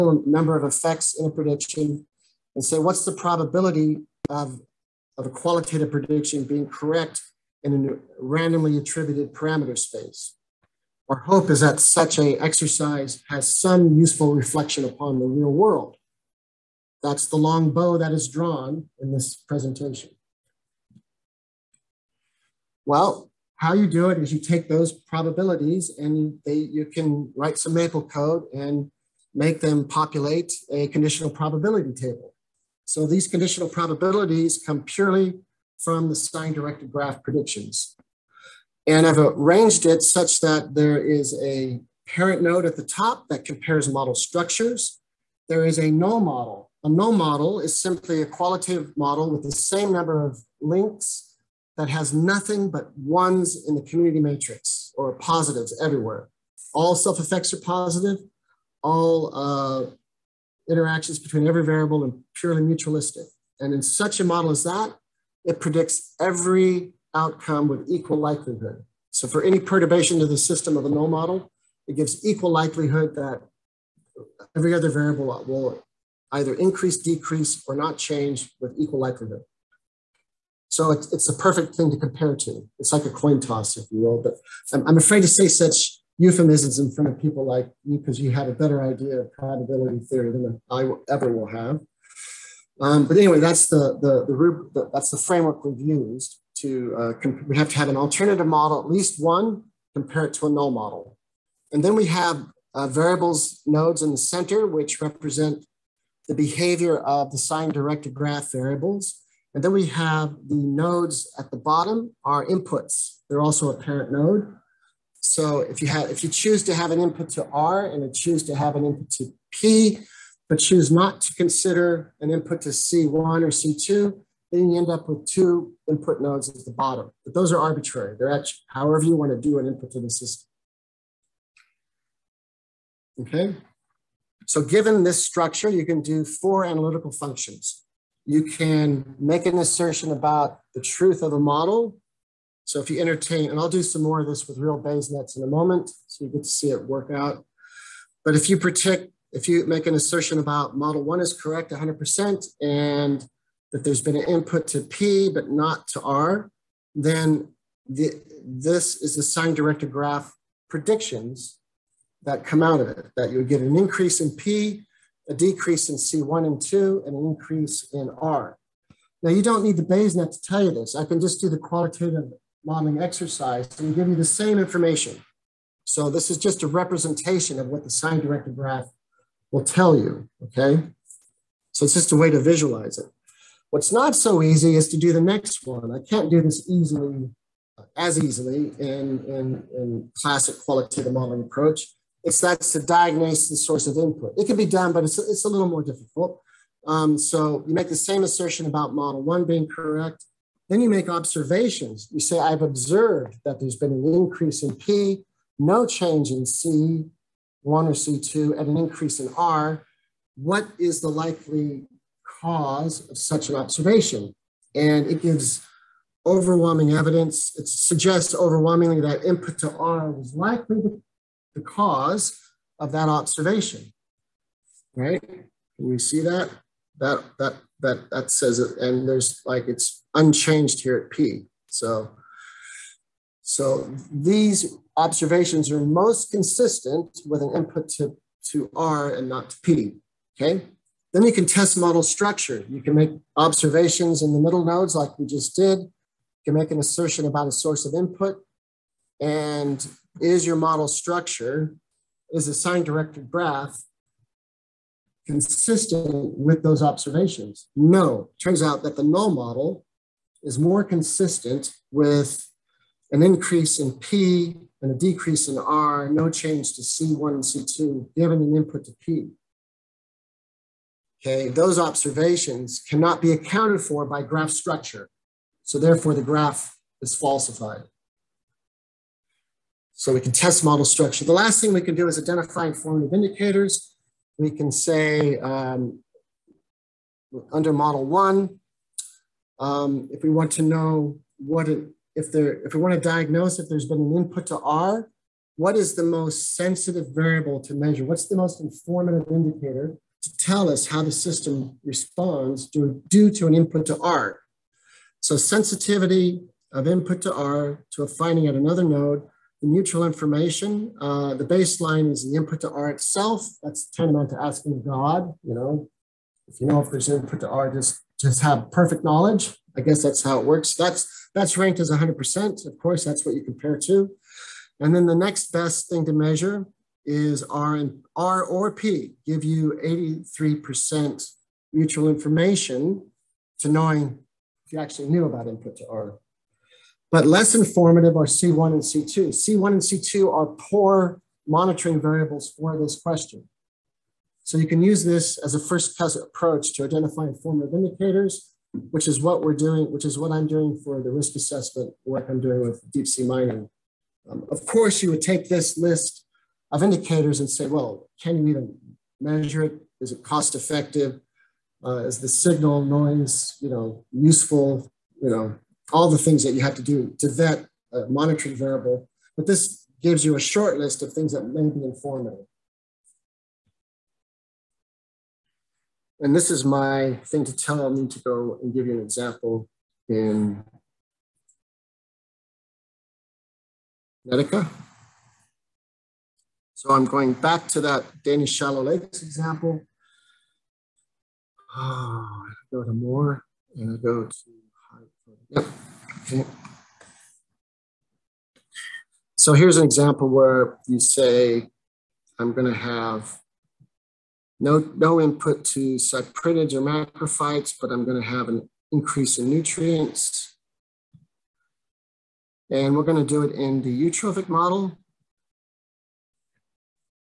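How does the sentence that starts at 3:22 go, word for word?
You say, I've observed that there's been an increase in P, no change in C1 or C2, and an increase in R.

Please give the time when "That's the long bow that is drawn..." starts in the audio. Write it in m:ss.
0:17.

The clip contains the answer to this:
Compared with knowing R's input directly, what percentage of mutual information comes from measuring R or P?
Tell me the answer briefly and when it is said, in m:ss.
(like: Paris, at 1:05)
83%, at 5:29.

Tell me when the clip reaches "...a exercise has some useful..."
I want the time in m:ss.
0:12.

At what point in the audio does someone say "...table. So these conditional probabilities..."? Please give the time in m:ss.
0:31.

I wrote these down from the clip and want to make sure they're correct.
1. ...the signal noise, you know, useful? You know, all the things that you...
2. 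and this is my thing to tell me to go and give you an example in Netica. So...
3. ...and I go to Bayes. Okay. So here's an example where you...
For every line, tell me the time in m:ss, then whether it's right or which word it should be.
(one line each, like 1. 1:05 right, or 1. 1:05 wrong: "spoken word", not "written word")
1. 6:02 right
2. 6:16 right
3. 6:33 wrong: "Yep", not "Bayes".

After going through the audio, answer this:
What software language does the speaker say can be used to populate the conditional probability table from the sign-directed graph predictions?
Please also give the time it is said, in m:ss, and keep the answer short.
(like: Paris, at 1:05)
Maple, at 0:27.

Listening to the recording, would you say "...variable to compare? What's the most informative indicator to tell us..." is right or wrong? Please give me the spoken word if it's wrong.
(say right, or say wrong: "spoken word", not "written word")
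wrong: "measure", not "compare".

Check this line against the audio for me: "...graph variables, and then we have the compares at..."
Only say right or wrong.
wrong.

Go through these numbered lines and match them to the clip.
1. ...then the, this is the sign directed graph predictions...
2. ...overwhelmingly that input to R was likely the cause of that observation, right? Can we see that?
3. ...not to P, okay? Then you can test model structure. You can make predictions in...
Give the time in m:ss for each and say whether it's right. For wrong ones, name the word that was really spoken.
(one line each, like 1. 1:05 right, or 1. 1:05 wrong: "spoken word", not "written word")
1. 2:36 right
2. 3:38 right
3. 3:59 wrong: "observations", not "predictions".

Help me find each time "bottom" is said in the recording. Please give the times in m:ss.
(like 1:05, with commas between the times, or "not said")
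1:51, 2:06.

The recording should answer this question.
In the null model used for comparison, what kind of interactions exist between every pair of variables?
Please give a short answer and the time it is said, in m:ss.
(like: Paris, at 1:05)
Purely mutualistic, at 1:02.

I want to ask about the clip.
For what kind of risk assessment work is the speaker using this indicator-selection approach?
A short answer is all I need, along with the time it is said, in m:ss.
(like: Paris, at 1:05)
Deep sea mining, at 5:52.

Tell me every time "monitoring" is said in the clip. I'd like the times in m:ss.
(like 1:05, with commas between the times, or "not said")
5:41, 6:08.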